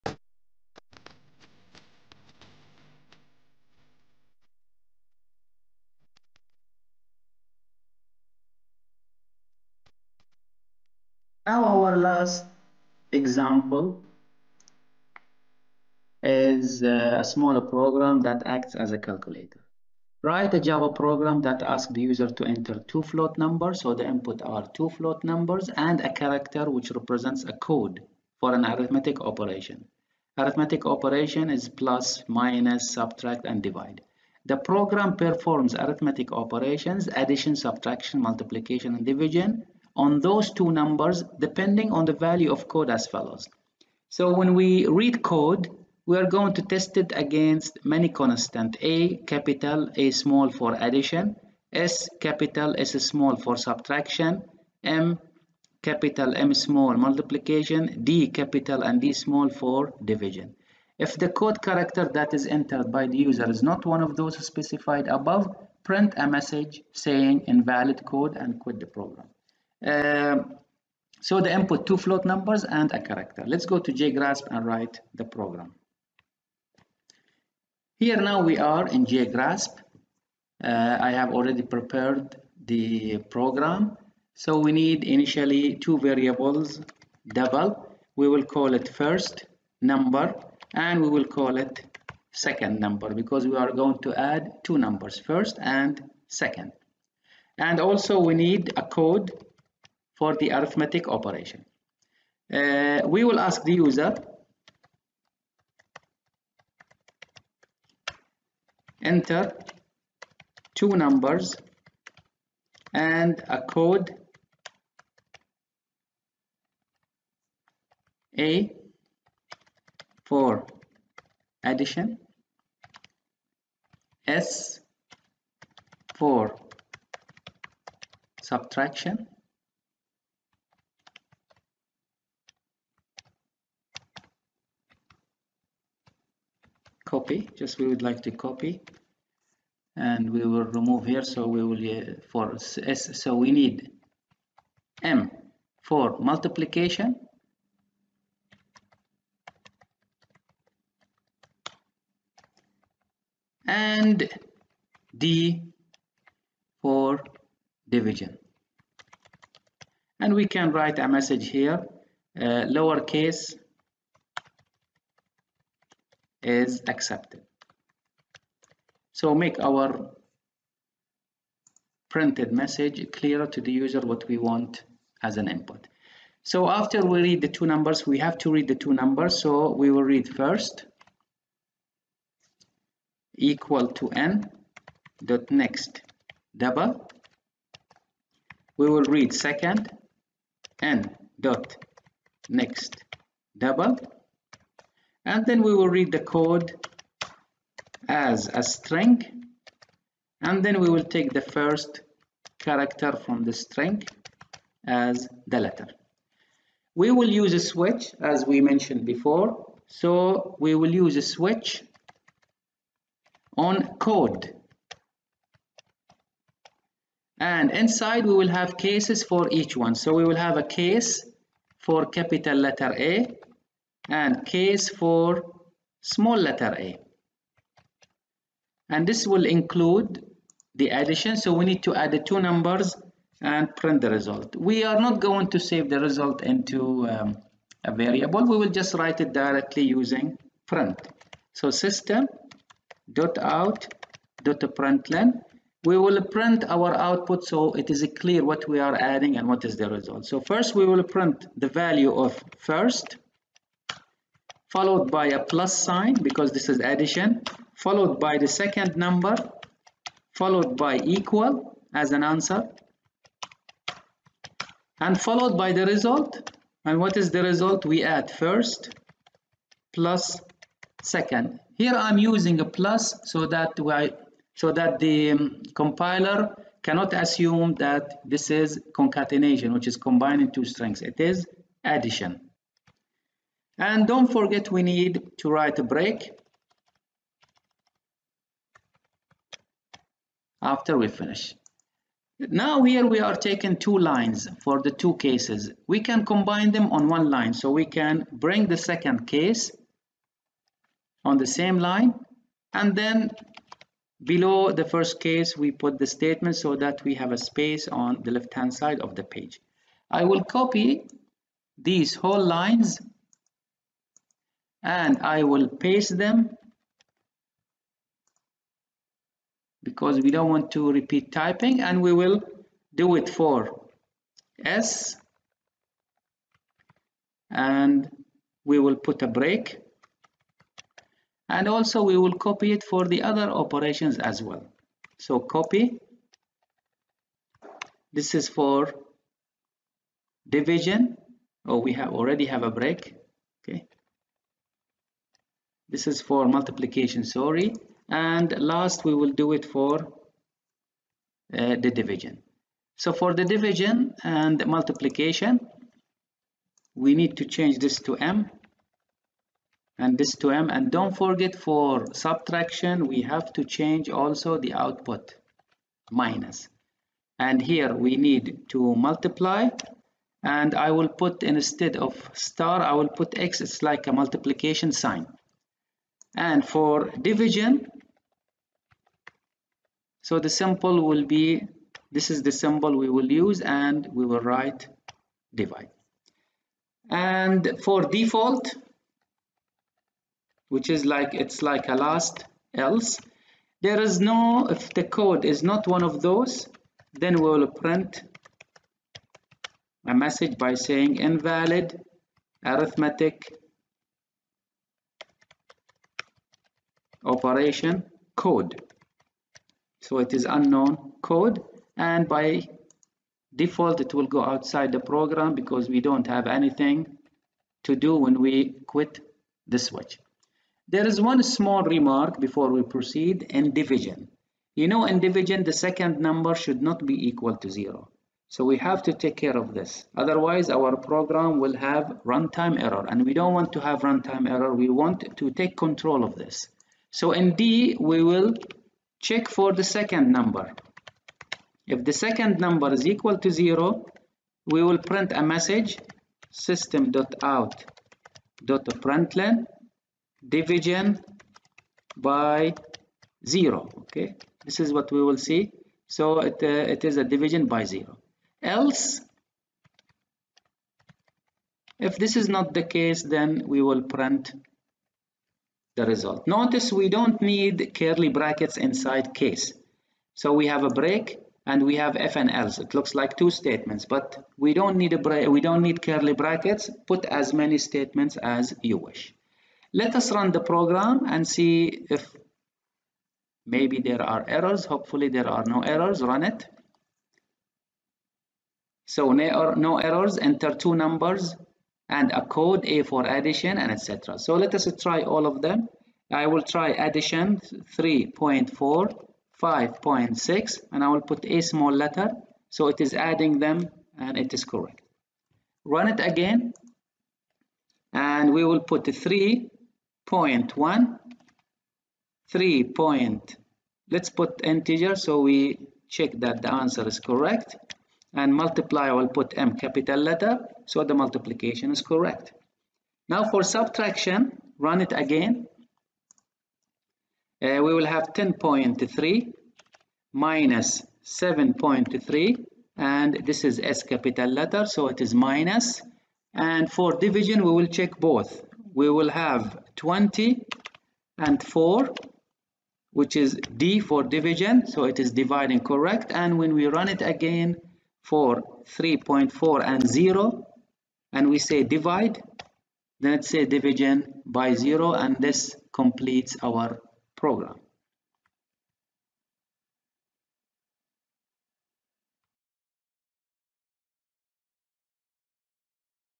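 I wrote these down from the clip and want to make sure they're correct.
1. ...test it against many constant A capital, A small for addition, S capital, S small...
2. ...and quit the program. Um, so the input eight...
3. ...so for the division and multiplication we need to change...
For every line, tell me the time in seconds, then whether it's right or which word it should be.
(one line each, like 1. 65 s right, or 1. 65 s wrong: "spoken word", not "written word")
1. 46 s right
2. 68 s wrong: "two", not "eight"
3. 352 s right.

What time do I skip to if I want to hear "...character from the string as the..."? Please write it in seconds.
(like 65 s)
202 s.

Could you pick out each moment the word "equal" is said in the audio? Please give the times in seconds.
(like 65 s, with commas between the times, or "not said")
183 s, 261 s, 427 s, 443 s.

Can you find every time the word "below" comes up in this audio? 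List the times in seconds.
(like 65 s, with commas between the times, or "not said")
304 s.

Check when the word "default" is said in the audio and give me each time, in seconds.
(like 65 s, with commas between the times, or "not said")
388 s, 413 s.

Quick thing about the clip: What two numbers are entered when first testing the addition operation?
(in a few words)
3.4 and 5.6.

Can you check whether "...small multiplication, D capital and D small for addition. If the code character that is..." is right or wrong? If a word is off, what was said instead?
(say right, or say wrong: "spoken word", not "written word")
wrong: "division", not "addition".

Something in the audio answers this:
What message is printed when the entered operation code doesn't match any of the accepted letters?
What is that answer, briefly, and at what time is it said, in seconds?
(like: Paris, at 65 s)
invalid arithmetic operation code, at 401 s.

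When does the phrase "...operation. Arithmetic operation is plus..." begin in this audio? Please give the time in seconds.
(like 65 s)
29 s.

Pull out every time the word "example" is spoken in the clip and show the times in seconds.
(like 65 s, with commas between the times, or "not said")
13 s.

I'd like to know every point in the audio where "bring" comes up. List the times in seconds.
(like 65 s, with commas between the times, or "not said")
298 s.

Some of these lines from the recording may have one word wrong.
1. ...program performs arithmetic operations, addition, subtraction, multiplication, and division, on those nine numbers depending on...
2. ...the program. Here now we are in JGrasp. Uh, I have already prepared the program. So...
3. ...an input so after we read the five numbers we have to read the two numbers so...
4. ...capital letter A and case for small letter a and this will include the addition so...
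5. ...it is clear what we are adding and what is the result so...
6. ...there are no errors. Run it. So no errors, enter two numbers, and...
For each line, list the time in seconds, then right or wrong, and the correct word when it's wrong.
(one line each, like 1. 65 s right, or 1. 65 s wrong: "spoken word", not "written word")
1. 34 s wrong: "two", not "nine"
2. 75 s right
3. 175 s wrong: "two", not "five"
4. 222 s right
5. 247 s right
6. 485 s right.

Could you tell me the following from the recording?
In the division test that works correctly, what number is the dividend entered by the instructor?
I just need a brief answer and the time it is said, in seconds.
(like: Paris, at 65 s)
20, at 539 s.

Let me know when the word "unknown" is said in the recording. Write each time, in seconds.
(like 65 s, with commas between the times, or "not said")
410 s.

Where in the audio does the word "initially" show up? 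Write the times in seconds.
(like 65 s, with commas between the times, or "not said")
85 s.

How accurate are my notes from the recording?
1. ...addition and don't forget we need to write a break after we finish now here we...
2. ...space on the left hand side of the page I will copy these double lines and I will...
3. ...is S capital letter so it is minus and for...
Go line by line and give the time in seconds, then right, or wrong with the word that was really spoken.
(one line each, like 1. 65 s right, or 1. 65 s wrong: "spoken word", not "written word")
1. 281 s right
2. 307 s wrong: "whole", not "double"
3. 533 s right.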